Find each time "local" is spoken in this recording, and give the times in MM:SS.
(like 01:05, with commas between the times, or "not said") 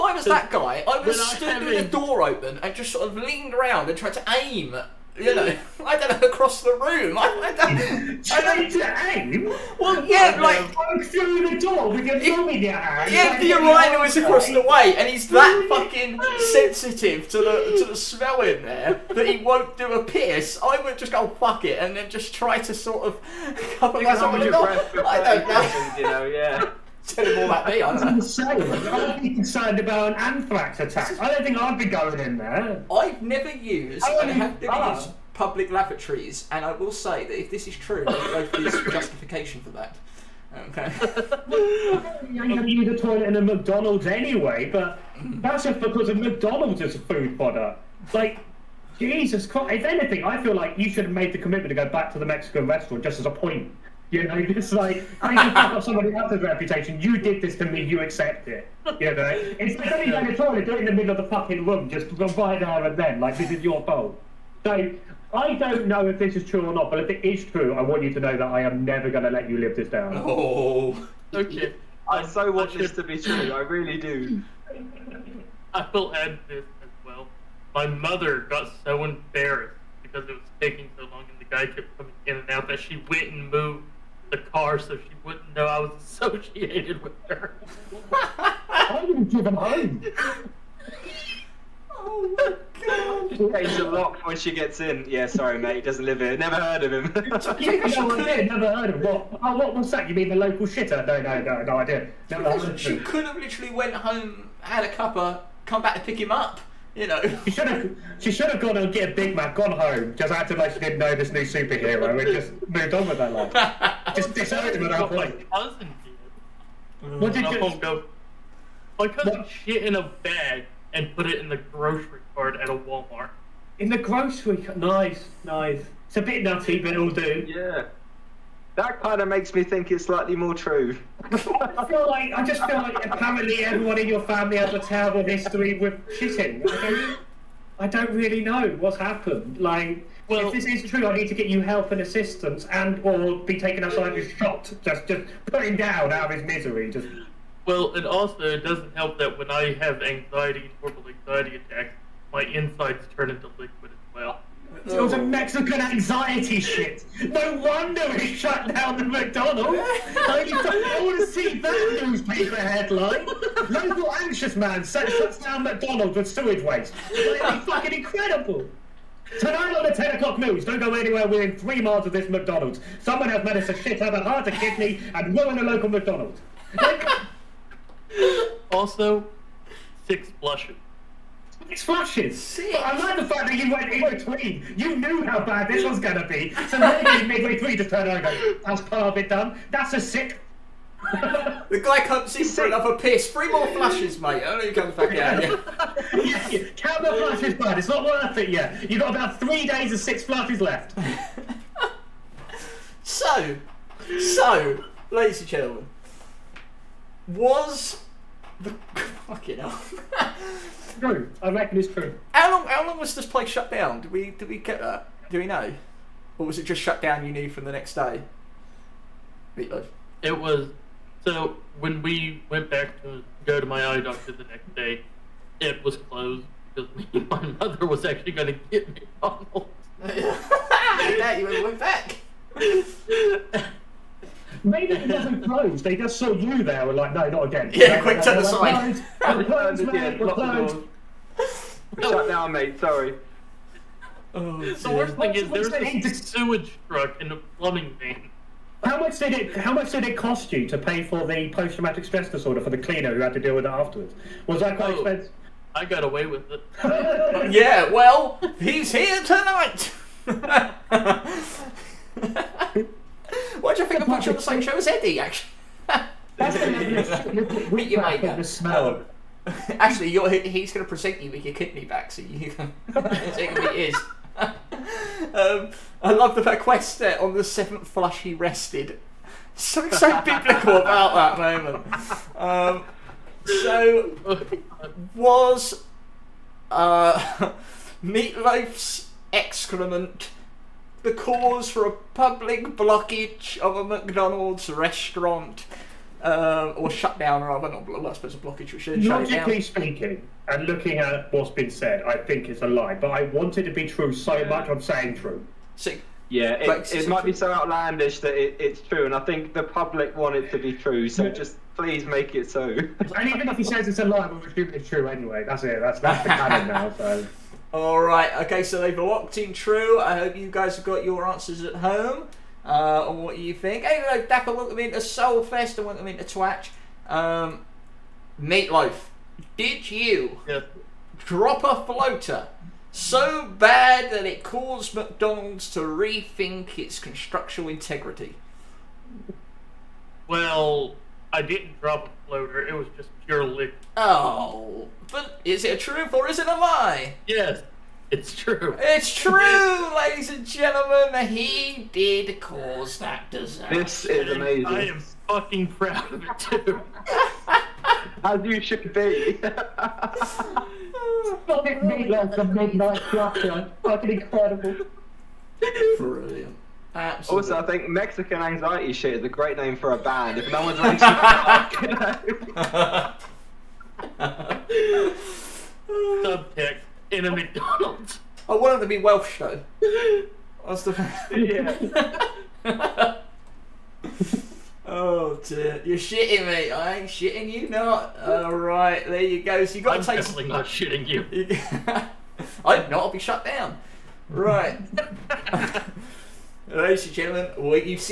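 01:40, 02:43, 02:55.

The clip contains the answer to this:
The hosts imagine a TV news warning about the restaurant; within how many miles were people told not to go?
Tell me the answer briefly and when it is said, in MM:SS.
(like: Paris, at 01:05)
3, at 02:51.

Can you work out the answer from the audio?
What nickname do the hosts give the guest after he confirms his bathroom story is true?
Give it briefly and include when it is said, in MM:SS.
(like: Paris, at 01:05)
Meatloaf the Midnight Flutter, at 06:01.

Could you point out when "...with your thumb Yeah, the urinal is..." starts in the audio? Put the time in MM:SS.
00:11.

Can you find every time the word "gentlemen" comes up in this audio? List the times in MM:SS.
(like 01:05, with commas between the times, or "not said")
03:25, 05:50, 06:37.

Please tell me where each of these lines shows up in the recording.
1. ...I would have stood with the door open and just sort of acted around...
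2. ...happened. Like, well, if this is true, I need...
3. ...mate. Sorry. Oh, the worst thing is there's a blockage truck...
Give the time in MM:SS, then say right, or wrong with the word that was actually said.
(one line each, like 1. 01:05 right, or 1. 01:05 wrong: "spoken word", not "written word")
1. 00:00 wrong: "leaned", not "acted"
2. 02:18 right
3. 04:02 wrong: "sewage", not "blockage".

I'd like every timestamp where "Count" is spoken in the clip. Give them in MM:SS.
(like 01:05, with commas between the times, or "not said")
03:16.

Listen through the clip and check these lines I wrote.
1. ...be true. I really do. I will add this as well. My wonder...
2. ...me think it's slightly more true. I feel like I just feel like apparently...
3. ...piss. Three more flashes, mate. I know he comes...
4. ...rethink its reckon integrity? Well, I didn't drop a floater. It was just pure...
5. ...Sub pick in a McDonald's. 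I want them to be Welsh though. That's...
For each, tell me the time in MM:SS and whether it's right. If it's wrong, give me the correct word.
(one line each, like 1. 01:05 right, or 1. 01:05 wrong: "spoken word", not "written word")
1. 01:13 wrong: "mother", not "wonder"
2. 02:09 right
3. 03:12 right
4. 05:35 wrong: "construction", not "reckon"
5. 06:14 right.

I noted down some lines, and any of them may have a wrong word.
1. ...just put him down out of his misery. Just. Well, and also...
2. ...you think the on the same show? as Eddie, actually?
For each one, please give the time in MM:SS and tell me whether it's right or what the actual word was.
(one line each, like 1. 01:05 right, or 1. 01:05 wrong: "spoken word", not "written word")
1. 02:25 right
2. 04:23 right.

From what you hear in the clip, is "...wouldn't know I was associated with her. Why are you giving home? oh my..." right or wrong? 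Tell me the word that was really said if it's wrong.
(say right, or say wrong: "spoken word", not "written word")
right.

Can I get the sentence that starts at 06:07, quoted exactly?
Also, I think Mexican Anxiety Shit is a great name for a band.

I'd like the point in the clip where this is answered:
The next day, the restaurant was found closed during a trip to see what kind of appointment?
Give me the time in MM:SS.
03:43.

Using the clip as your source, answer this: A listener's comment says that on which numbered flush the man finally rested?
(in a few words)
seventh.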